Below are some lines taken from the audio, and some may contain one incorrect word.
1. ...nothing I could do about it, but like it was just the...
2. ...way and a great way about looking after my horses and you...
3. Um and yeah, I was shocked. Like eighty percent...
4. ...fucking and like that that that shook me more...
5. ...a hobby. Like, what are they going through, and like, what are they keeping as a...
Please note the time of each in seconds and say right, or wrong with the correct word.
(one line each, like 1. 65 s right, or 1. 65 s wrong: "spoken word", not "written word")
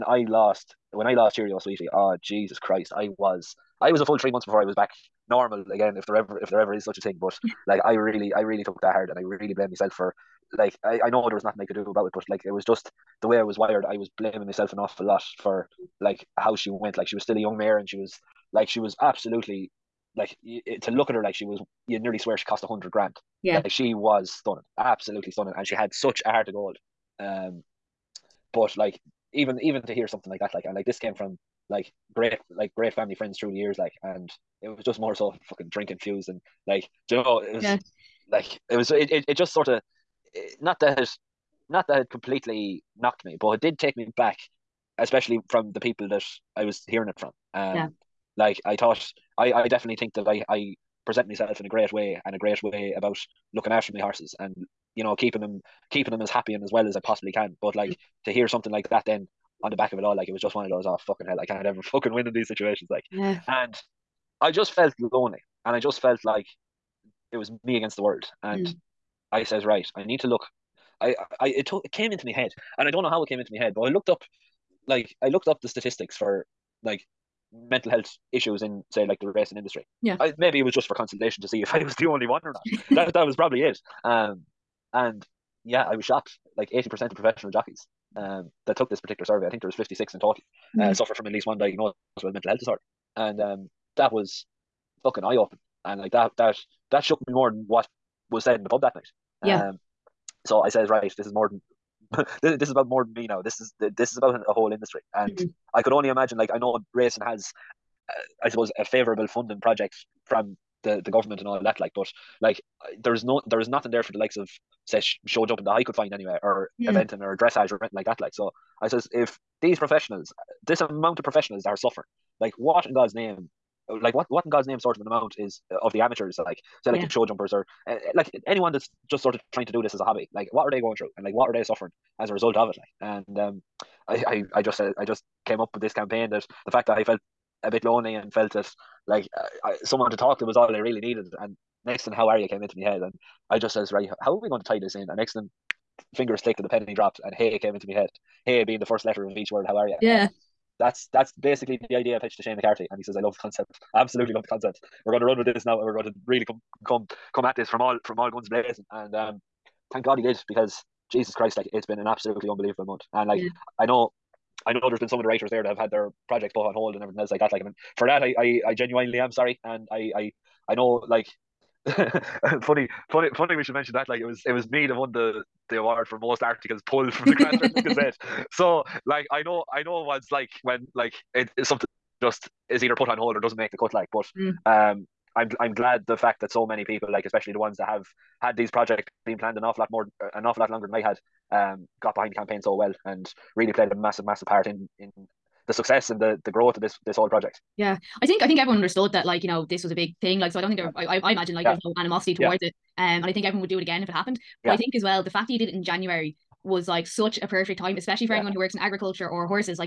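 1. 11 s right
2. 51 s right
3. 84 s right
4. 95 s wrong: "opening", not "fucking"
5. 129 s wrong: "suffering", not "keeping".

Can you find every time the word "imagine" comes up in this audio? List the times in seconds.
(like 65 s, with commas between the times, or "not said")
106 s, 201 s.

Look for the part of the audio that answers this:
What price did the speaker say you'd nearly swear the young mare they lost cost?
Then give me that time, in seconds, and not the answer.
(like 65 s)
22 s.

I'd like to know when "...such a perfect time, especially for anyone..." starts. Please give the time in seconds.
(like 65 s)
207 s.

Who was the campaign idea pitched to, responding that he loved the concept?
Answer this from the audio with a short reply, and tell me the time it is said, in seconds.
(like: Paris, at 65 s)
Shane McCarthy, at 152 s.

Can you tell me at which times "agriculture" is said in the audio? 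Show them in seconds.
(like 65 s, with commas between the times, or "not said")
208 s.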